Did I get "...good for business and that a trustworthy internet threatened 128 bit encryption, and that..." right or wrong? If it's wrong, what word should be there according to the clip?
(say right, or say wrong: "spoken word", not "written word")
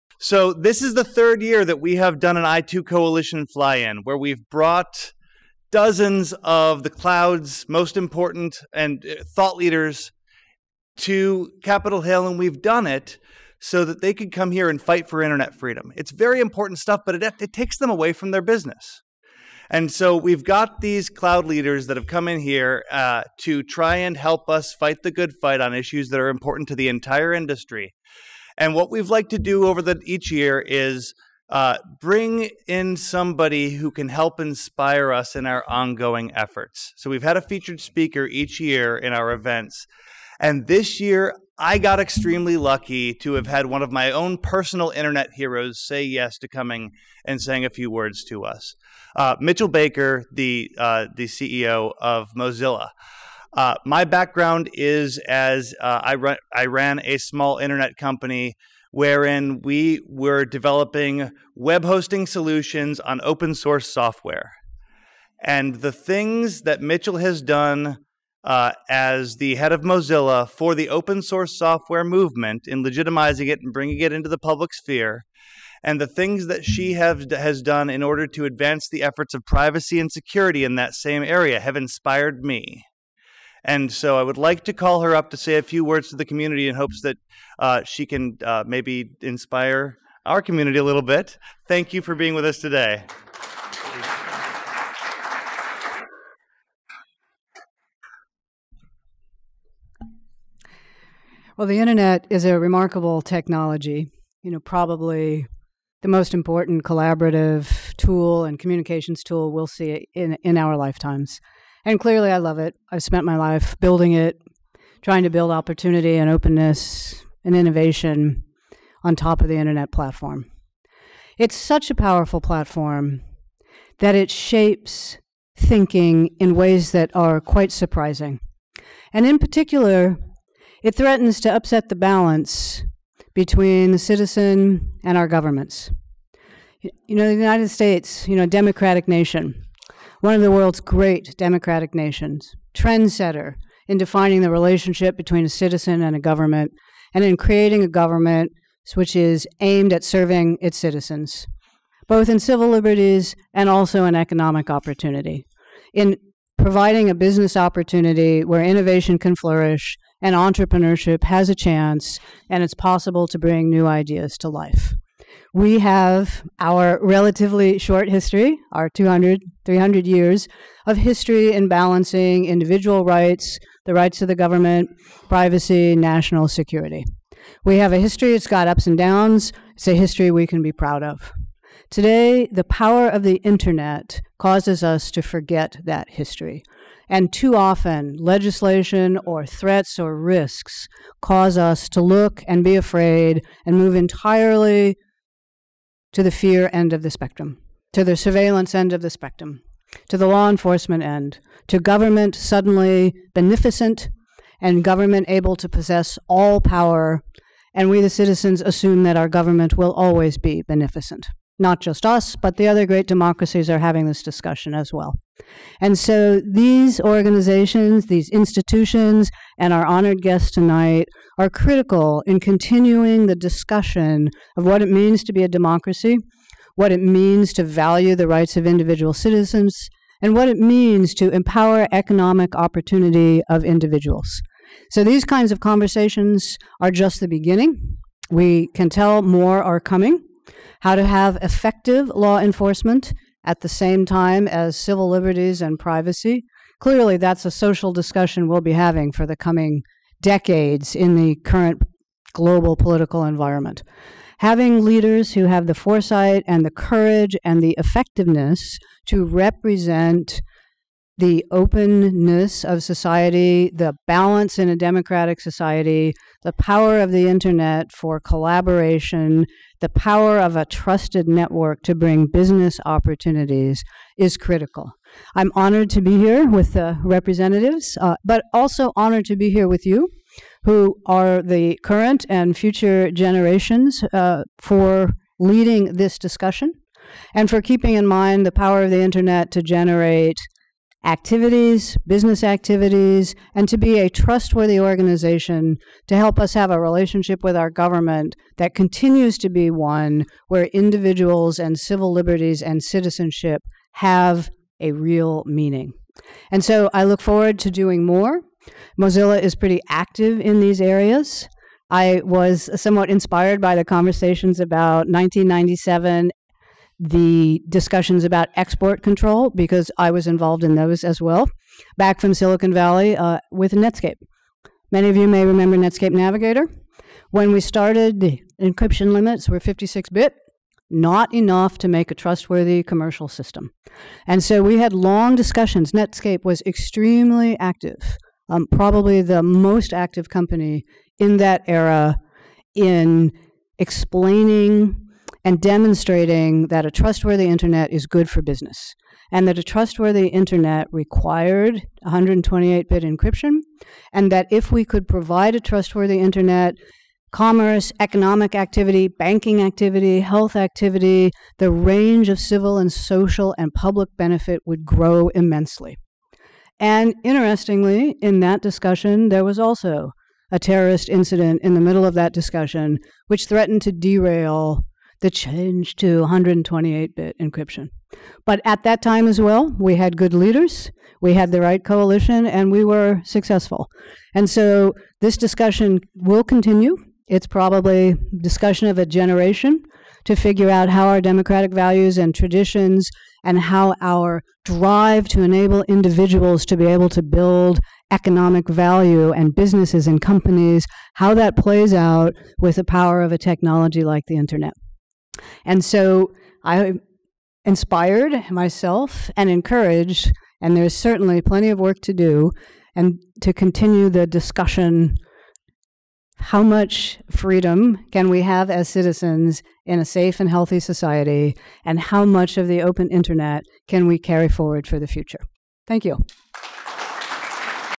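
wrong: "required", not "threatened".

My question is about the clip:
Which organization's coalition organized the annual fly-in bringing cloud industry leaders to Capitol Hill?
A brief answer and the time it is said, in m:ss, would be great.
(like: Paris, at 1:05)
I2 coalition, at 0:02.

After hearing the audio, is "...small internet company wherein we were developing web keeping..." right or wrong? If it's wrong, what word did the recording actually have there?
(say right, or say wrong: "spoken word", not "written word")
wrong: "hosting", not "keeping".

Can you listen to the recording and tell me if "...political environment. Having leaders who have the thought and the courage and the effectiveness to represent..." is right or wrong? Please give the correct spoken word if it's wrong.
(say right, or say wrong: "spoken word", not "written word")
wrong: "foresight", not "thought".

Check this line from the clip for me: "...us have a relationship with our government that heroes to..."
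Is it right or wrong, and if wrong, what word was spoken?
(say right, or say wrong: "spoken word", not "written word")
wrong: "continues", not "heroes".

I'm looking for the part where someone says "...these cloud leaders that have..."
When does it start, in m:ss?
0:20.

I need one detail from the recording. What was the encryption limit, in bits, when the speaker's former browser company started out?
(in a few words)
56 bit.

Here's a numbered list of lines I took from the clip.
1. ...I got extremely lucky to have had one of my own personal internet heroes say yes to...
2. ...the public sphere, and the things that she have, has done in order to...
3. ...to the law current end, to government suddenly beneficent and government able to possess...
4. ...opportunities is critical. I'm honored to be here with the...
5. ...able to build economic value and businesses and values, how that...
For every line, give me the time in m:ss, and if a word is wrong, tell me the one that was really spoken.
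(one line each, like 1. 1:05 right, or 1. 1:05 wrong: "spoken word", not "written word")
1. 0:41 right
2. 1:14 right
3. 3:20 wrong: "enforcement", not "current"
4. 4:32 right
5. 6:36 wrong: "companies", not "values".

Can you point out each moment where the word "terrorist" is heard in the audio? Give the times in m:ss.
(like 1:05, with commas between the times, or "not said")
6:10.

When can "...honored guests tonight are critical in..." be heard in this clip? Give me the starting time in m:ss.
3:39.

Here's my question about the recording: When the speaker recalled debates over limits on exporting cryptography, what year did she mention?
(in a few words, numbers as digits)
1997.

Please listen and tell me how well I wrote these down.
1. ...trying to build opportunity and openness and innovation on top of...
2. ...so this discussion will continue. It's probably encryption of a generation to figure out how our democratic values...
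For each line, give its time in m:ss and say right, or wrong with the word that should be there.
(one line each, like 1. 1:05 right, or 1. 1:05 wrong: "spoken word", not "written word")
1. 1:55 right
2. 6:24 wrong: "discussion", not "encryption".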